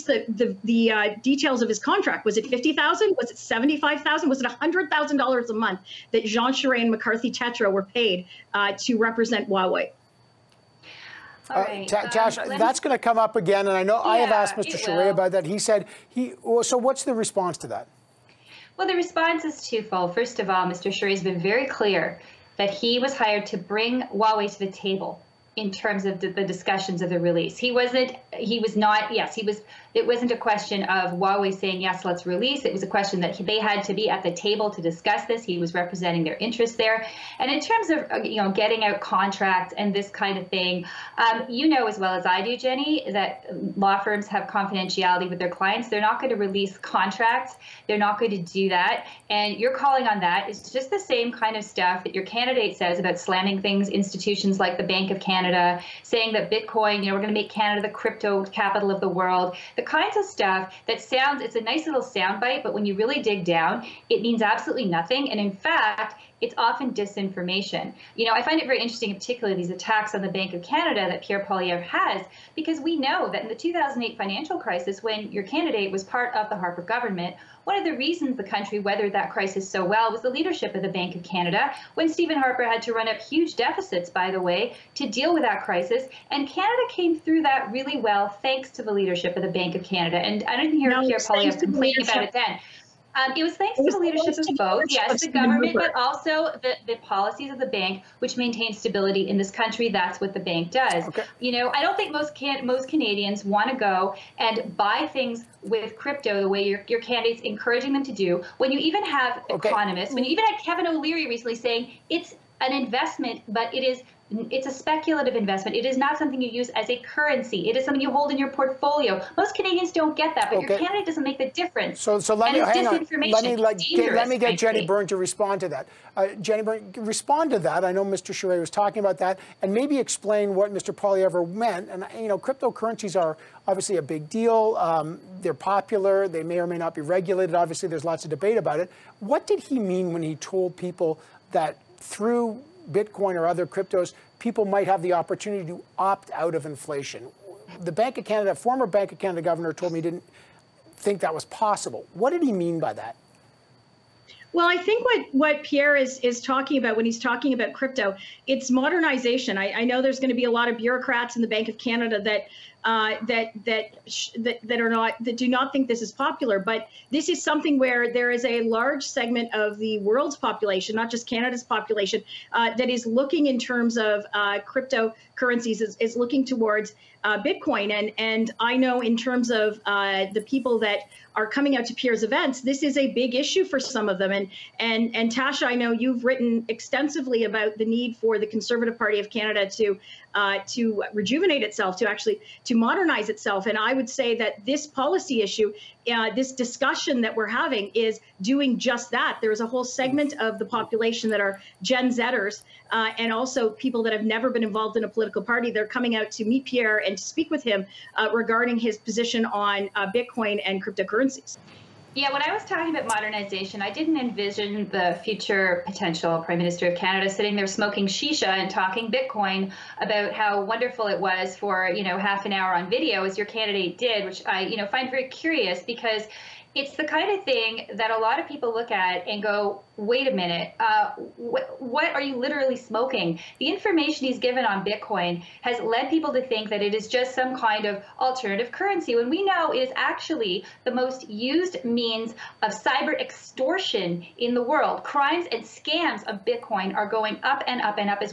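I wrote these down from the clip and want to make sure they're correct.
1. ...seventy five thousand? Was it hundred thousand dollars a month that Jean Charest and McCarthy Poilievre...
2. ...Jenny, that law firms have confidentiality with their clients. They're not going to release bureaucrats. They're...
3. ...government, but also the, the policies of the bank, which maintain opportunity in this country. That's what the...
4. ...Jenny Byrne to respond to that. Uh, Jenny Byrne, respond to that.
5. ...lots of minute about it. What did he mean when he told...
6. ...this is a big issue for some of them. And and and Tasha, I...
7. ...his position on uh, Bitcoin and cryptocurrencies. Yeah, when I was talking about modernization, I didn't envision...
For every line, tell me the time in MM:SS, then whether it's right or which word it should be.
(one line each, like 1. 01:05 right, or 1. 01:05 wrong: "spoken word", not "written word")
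1. 00:03 wrong: "Tétrault", not "Poilievre"
2. 00:42 wrong: "contracts", not "bureaucrats"
3. 01:35 wrong: "stability", not "opportunity"
4. 02:04 right
5. 02:18 wrong: "debate", not "minute"
6. 03:02 right
7. 03:28 right.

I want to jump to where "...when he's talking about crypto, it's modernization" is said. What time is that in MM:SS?
02:36.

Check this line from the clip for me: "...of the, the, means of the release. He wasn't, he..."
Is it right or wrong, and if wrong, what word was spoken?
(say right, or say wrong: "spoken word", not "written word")
wrong: "discussions", not "means".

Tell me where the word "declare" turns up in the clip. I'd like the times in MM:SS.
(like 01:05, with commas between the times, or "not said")
not said.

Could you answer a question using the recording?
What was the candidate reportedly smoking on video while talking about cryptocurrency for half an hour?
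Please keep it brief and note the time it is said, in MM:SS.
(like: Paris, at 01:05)
Shisha, at 03:38.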